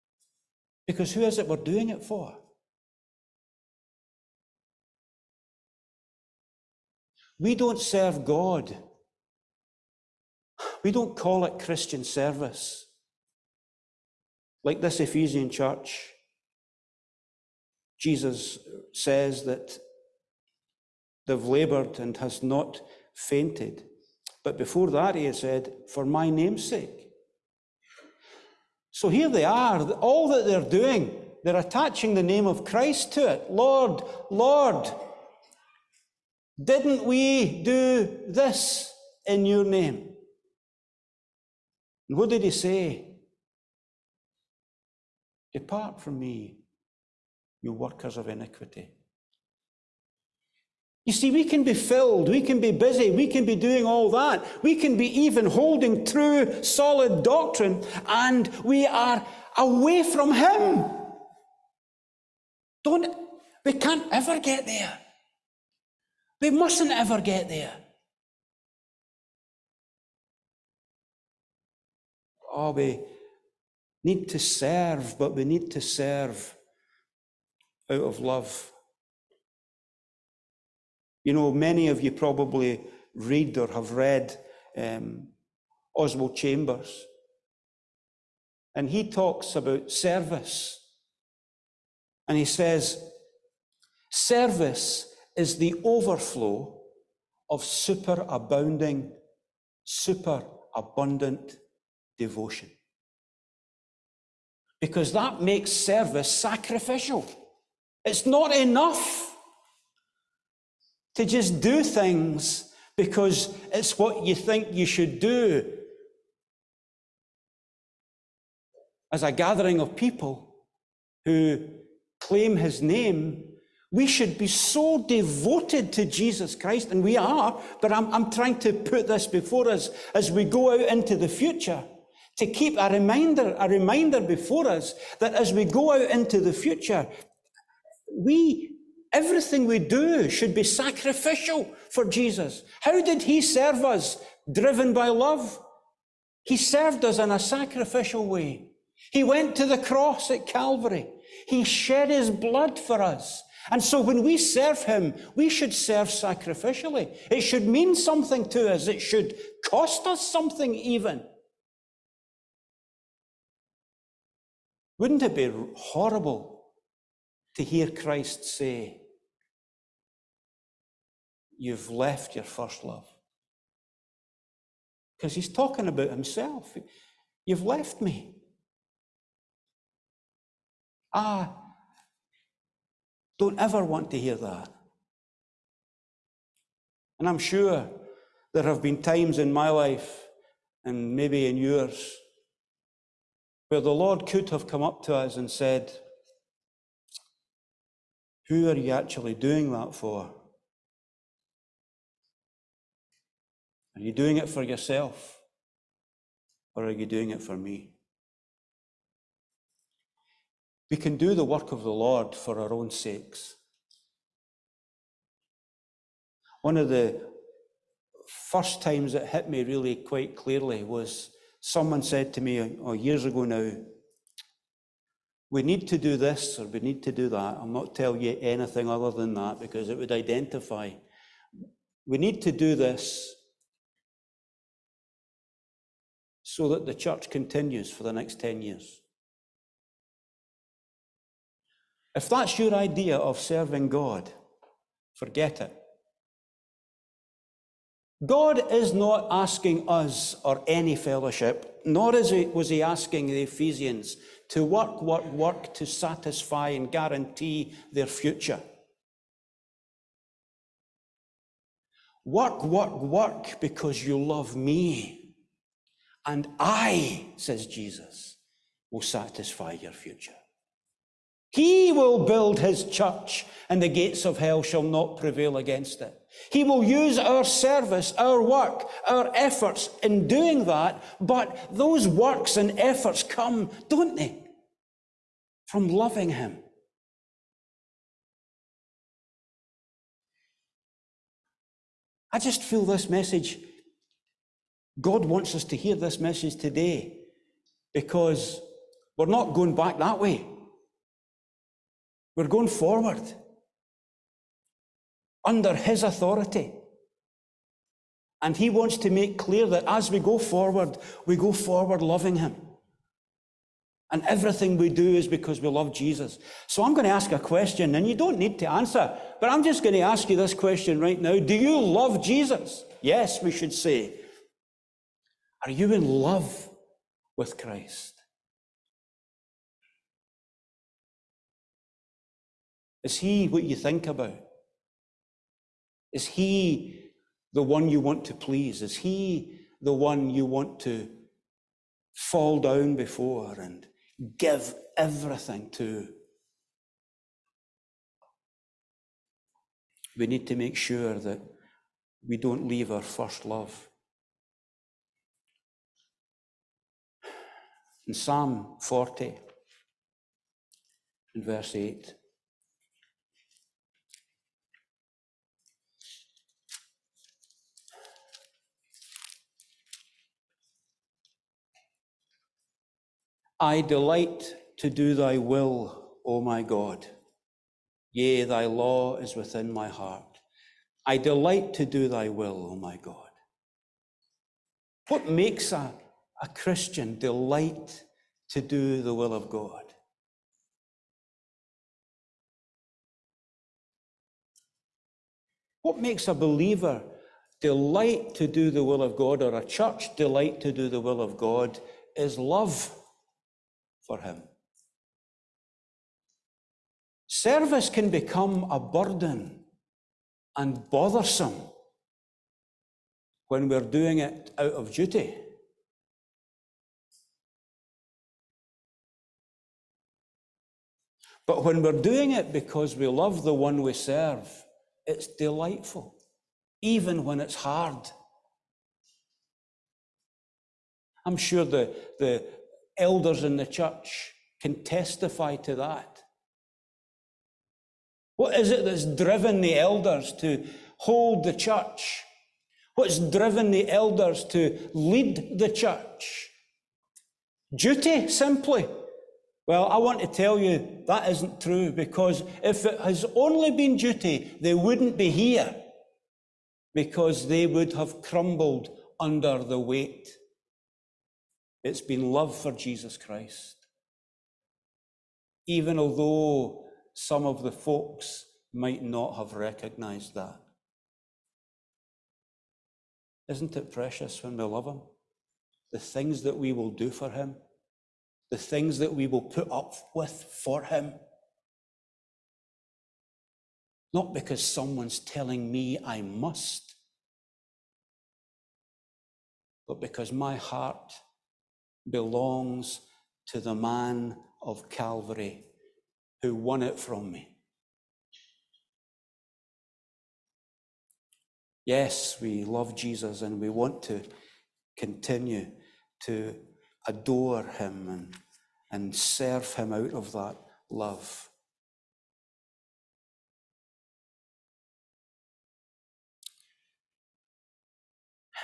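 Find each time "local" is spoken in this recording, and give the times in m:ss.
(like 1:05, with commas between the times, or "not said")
not said.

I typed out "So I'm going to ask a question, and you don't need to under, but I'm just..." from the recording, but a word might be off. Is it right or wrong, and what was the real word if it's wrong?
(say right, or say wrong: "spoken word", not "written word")
wrong: "answer", not "under".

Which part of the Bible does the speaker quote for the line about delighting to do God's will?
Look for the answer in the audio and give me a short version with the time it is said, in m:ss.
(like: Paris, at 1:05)
Psalm 40, at 5:58.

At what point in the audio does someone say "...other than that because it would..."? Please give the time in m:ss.
3:48.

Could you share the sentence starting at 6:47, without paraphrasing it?
Service can become a burden and bothersome when we're doing it out of duty.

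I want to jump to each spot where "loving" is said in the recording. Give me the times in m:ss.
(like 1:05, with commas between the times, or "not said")
4:45, 5:12.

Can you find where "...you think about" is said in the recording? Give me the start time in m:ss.
5:33.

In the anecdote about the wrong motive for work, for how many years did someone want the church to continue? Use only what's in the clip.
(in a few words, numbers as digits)
10 years.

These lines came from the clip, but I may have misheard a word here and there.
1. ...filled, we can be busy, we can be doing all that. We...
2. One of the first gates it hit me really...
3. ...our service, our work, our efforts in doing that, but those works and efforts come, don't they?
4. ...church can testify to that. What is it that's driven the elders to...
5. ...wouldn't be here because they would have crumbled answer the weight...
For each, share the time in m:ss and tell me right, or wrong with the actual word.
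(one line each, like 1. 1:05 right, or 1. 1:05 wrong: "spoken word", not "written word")
1. 0:51 right
2. 3:36 wrong: "times", not "gates"
3. 4:37 right
4. 7:13 right
5. 7:34 wrong: "under", not "answer".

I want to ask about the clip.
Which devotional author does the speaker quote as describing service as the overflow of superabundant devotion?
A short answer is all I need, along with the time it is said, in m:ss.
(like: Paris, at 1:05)
Oswald Chambers, at 1:25.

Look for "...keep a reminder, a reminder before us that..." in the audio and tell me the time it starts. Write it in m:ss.
2:12.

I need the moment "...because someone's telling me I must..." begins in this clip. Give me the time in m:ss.
8:04.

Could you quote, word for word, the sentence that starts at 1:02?
Don't, we can't ever get there.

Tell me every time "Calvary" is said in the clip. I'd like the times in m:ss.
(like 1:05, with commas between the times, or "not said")
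2:30, 8:14.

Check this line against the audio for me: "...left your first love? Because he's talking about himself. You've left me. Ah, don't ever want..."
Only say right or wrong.
right.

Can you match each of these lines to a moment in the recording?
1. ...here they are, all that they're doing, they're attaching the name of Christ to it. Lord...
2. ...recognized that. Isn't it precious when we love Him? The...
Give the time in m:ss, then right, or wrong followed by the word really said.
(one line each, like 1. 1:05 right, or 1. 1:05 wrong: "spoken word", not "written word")
1. 0:29 right
2. 7:49 right.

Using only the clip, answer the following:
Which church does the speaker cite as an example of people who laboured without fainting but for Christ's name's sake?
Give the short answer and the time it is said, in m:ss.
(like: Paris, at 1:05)
Ephesian church, at 0:14.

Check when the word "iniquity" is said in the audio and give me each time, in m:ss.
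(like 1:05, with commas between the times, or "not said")
0:48.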